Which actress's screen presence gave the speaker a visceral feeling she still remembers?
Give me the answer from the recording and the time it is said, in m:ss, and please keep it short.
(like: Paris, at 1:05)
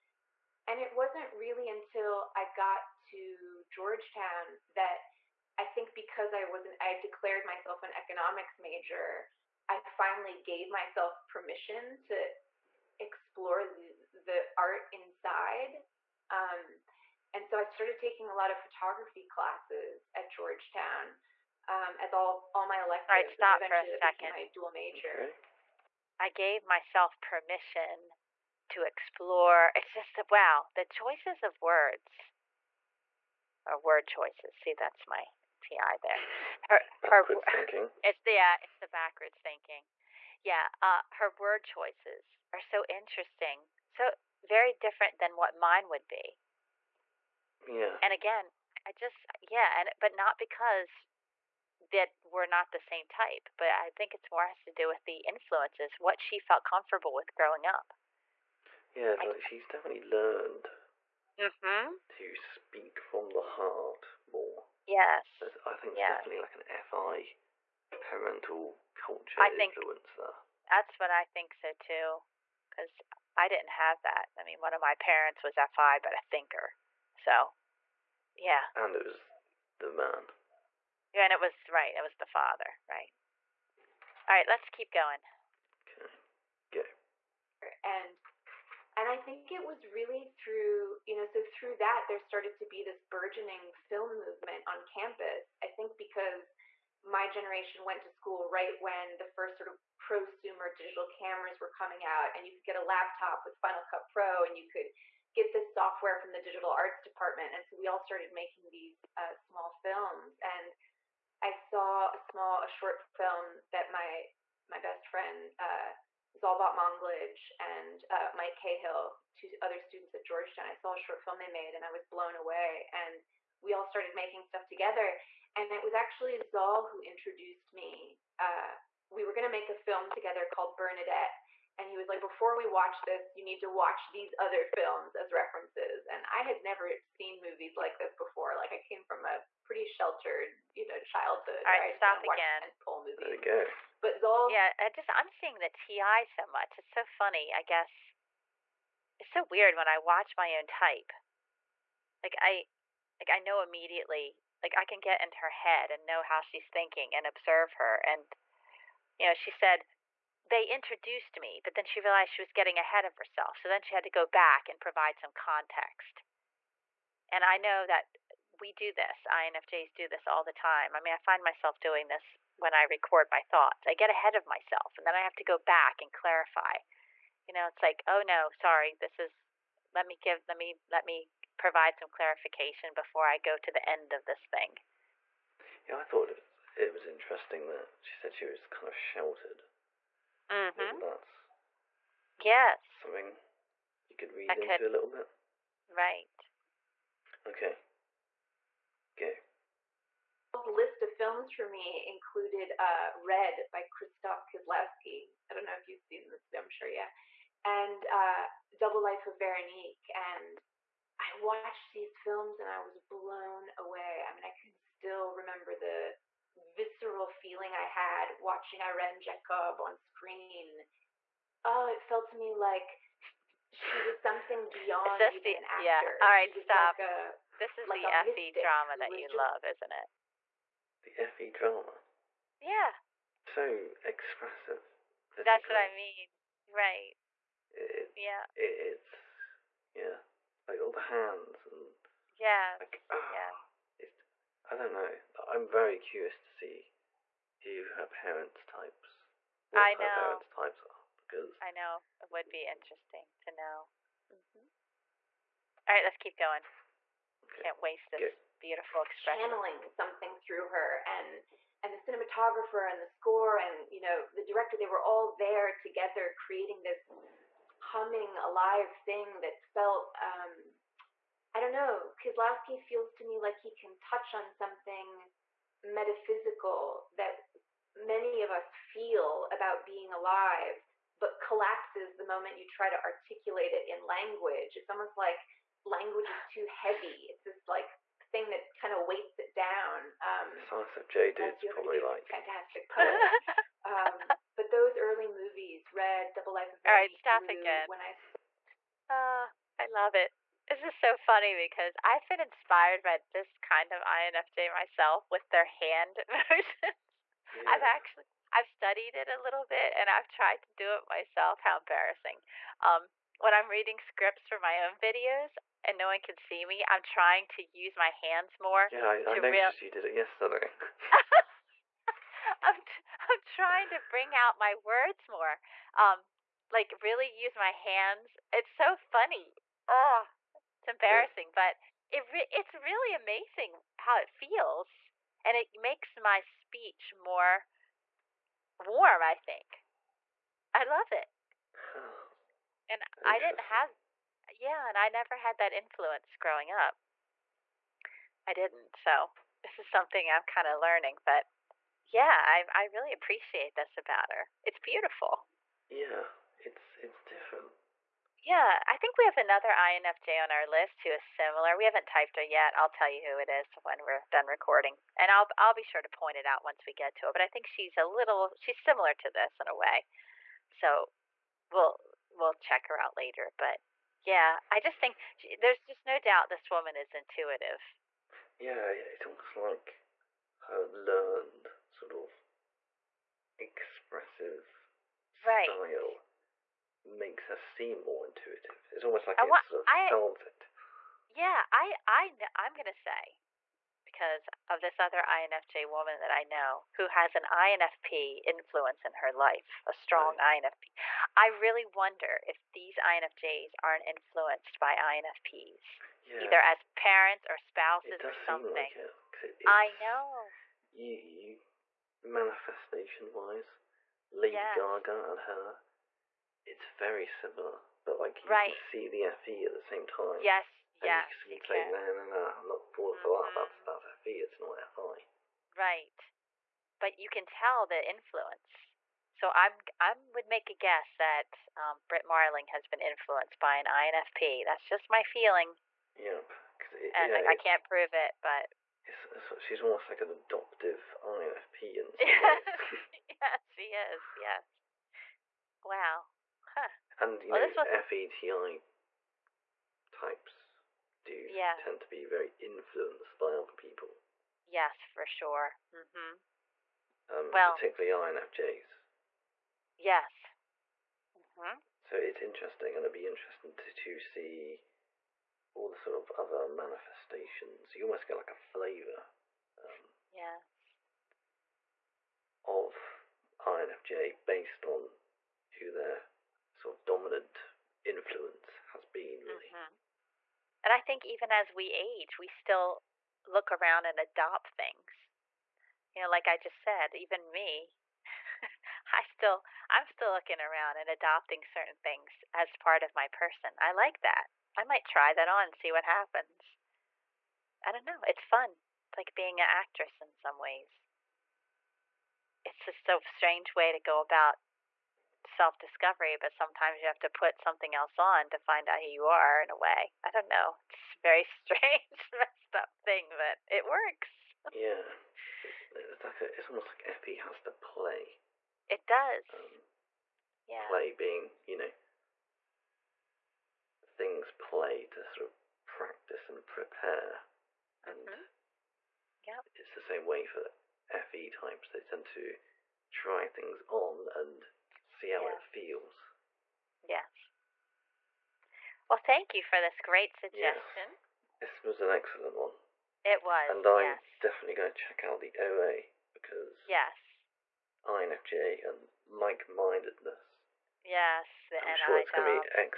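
Irene Jacob, at 3:38.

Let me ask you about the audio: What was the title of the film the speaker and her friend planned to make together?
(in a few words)
Bernadette.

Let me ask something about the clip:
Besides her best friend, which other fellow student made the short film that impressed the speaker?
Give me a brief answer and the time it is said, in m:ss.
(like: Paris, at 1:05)
Mike Cahill, at 1:58.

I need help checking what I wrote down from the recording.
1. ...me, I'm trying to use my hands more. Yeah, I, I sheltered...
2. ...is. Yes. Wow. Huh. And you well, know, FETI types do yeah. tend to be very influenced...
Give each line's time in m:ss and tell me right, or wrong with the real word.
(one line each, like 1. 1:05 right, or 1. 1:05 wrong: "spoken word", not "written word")
1. 5:16 wrong: "noticed", not "sheltered"
2. 7:23 right.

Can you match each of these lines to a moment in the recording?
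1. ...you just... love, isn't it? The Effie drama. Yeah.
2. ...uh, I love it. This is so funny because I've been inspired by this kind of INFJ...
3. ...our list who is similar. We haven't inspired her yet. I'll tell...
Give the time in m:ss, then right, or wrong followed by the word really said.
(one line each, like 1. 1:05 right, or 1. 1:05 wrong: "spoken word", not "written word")
1. 3:49 right
2. 4:59 right
3. 6:00 wrong: "typed", not "inspired".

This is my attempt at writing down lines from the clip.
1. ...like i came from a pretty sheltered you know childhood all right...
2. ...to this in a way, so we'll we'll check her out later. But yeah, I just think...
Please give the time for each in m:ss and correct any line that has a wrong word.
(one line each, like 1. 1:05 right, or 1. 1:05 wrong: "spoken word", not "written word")
1. 2:18 right
2. 6:09 right.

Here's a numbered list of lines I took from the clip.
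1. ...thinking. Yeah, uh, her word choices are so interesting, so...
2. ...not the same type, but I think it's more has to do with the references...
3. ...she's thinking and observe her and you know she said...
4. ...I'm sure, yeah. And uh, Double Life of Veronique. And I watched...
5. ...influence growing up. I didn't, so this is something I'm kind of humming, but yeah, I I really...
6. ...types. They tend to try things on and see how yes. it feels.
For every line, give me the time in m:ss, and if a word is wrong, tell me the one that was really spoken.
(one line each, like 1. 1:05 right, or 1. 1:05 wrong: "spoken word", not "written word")
1. 0:39 right
2. 0:52 wrong: "influences", not "references"
3. 2:36 right
4. 3:26 right
5. 5:45 wrong: "learning", not "humming"
6. 8:51 right.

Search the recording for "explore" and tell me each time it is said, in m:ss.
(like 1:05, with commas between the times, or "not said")
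0:12, 0:28.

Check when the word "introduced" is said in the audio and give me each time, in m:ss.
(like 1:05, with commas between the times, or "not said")
2:07, 2:40.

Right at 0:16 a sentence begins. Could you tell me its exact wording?
Um, and so I started taking a lot of photography classes at Georgetown um, as all all my electives.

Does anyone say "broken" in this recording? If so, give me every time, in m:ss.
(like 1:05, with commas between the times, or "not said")
not said.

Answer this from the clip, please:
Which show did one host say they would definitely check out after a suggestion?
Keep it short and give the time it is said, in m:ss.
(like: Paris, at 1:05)
The OA, at 9:05.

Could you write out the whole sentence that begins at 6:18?
Yeah, it's almost like her learned sort of expressive right.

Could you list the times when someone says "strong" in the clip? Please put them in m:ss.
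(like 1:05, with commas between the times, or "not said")
6:39.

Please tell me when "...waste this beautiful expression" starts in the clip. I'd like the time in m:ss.
4:17.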